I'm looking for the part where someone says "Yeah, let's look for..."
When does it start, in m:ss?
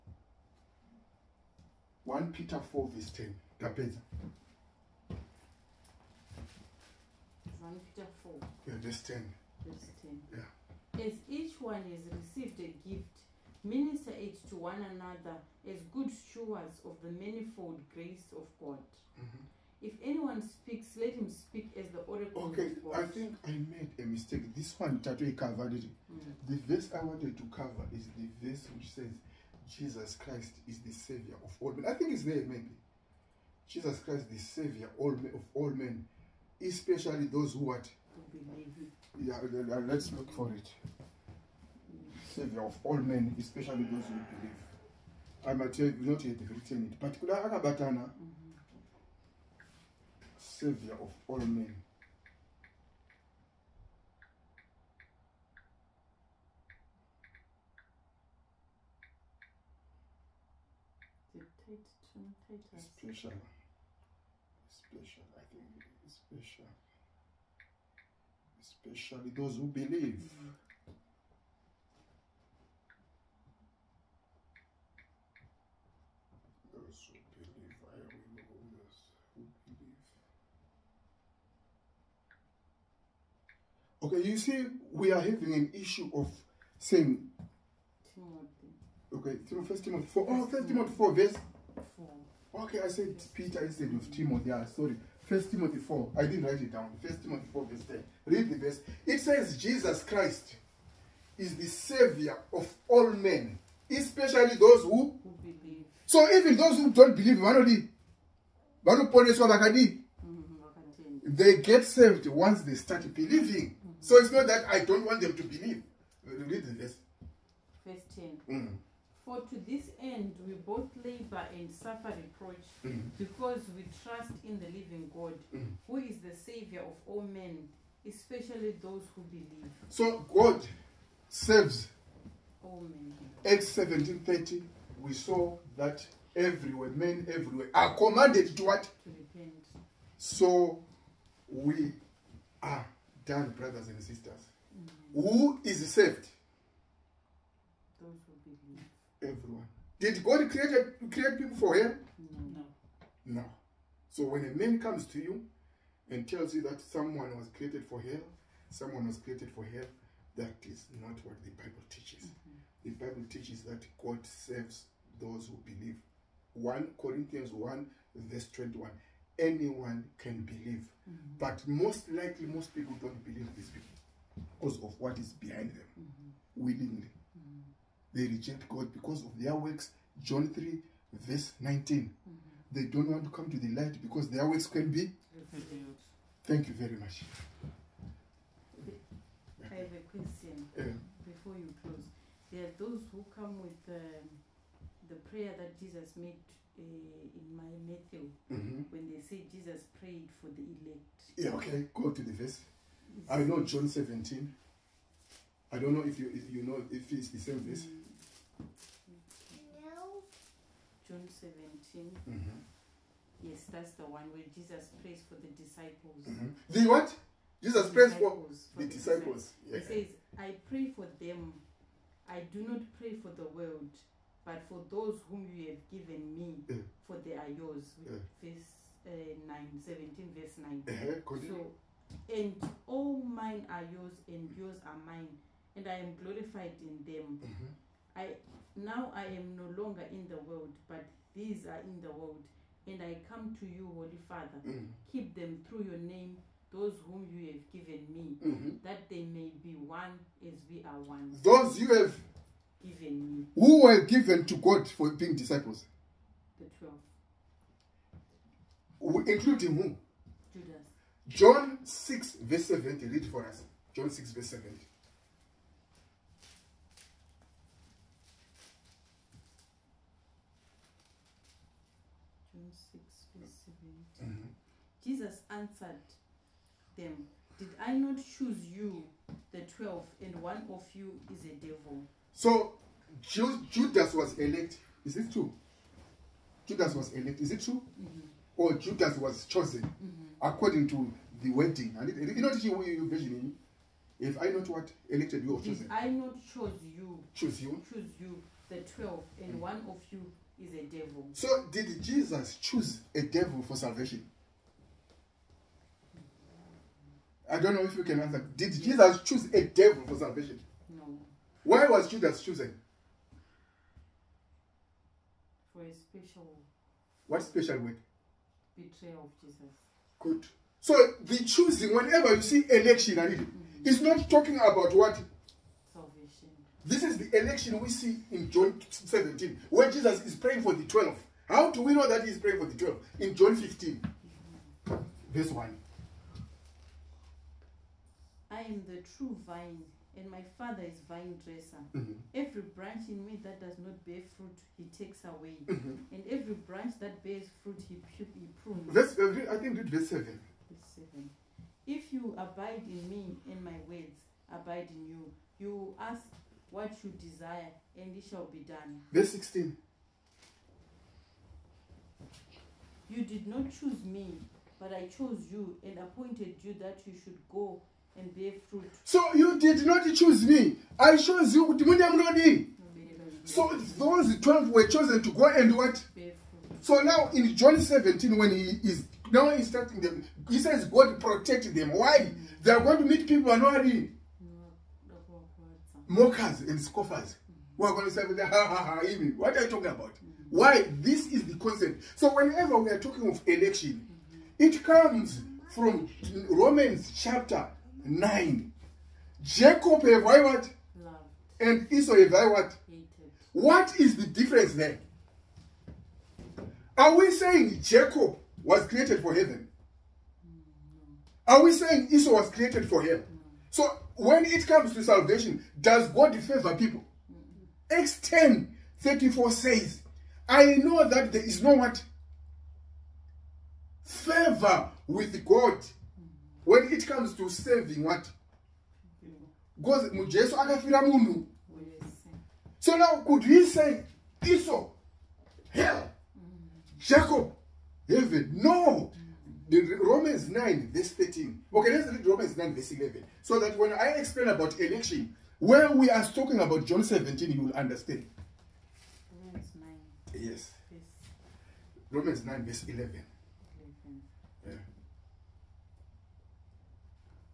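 0:39.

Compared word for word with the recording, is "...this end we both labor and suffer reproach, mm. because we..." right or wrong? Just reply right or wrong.
right.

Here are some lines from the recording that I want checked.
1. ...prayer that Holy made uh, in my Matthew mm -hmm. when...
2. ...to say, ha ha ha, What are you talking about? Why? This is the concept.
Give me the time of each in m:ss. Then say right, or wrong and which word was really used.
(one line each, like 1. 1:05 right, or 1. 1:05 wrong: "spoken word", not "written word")
1. 3:15 wrong: "Jesus", not "Holy"
2. 6:28 right.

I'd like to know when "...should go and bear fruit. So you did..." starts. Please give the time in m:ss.
6:07.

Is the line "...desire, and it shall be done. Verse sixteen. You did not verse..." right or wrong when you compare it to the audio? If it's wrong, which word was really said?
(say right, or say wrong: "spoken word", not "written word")
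wrong: "choose", not "verse".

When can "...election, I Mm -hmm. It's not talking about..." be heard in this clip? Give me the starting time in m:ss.
5:22.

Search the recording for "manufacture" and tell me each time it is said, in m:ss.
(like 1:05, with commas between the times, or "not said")
0:07.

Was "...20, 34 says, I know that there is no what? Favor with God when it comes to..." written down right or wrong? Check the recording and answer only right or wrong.
wrong.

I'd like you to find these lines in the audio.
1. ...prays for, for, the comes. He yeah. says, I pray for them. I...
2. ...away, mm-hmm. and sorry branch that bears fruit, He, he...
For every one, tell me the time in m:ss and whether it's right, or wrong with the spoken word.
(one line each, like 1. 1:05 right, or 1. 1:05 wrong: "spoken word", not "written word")
1. 3:37 wrong: "disciples", not "comes"
2. 5:45 wrong: "every", not "sorry".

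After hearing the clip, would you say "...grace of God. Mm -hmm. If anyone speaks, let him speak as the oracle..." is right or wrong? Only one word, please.
right.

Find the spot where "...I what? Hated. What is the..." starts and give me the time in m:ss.
6:42.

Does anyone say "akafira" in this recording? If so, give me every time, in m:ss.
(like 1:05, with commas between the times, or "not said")
7:09.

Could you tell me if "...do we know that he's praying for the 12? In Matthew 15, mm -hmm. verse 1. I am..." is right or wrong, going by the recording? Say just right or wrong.
wrong.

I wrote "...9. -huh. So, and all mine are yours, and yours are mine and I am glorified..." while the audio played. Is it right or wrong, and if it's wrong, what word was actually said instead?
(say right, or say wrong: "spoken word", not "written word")
right.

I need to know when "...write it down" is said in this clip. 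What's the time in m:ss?
1:36.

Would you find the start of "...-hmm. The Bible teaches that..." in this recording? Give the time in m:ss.
2:42.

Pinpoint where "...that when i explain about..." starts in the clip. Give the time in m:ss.
7:23.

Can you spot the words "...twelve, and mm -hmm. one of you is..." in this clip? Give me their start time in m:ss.
4:58.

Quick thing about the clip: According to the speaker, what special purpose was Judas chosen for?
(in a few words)
Betrayal of Jesus.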